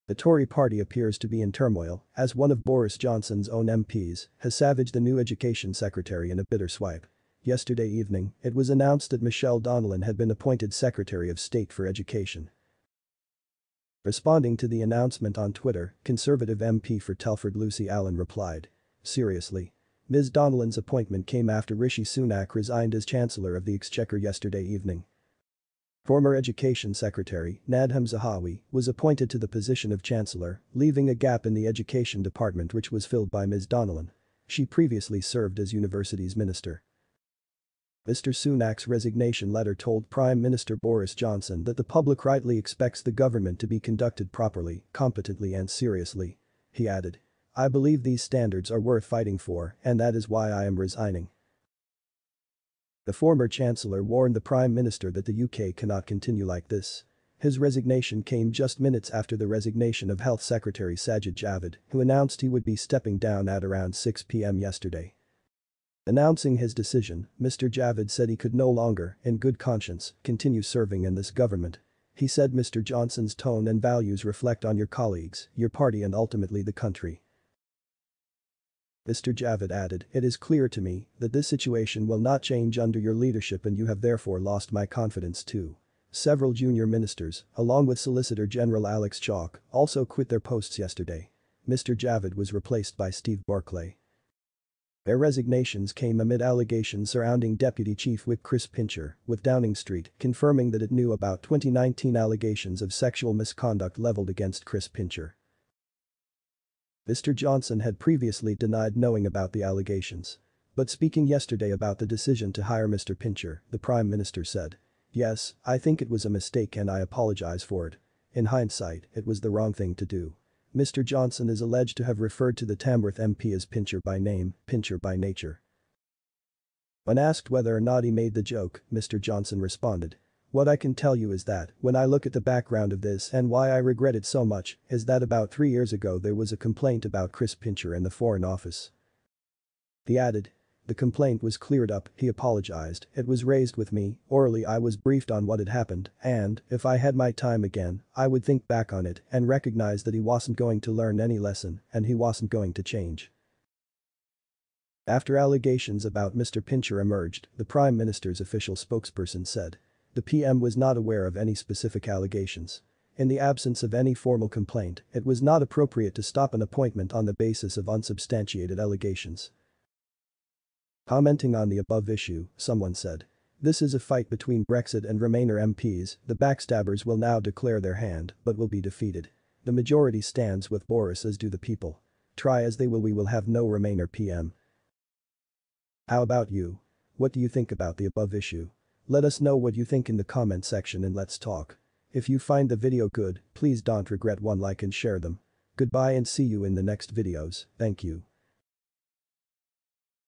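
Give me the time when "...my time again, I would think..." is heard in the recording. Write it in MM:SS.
02:27.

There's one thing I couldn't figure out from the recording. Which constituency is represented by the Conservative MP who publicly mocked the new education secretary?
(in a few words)
Telford.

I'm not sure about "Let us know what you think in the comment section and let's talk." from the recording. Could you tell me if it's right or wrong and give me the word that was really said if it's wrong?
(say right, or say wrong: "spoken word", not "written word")
right.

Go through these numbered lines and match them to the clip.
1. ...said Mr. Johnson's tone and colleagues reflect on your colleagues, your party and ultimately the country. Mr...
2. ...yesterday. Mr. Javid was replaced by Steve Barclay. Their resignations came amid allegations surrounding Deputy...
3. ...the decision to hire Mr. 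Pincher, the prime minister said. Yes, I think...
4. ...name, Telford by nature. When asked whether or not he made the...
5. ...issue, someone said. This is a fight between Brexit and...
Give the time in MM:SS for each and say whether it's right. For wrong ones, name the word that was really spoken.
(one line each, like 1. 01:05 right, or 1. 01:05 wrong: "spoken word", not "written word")
1. 01:12 wrong: "values", not "colleagues"
2. 01:30 right
3. 01:51 right
4. 02:04 wrong: "Pincher", not "Telford"
5. 02:52 right.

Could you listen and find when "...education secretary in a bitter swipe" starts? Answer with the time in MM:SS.
00:05.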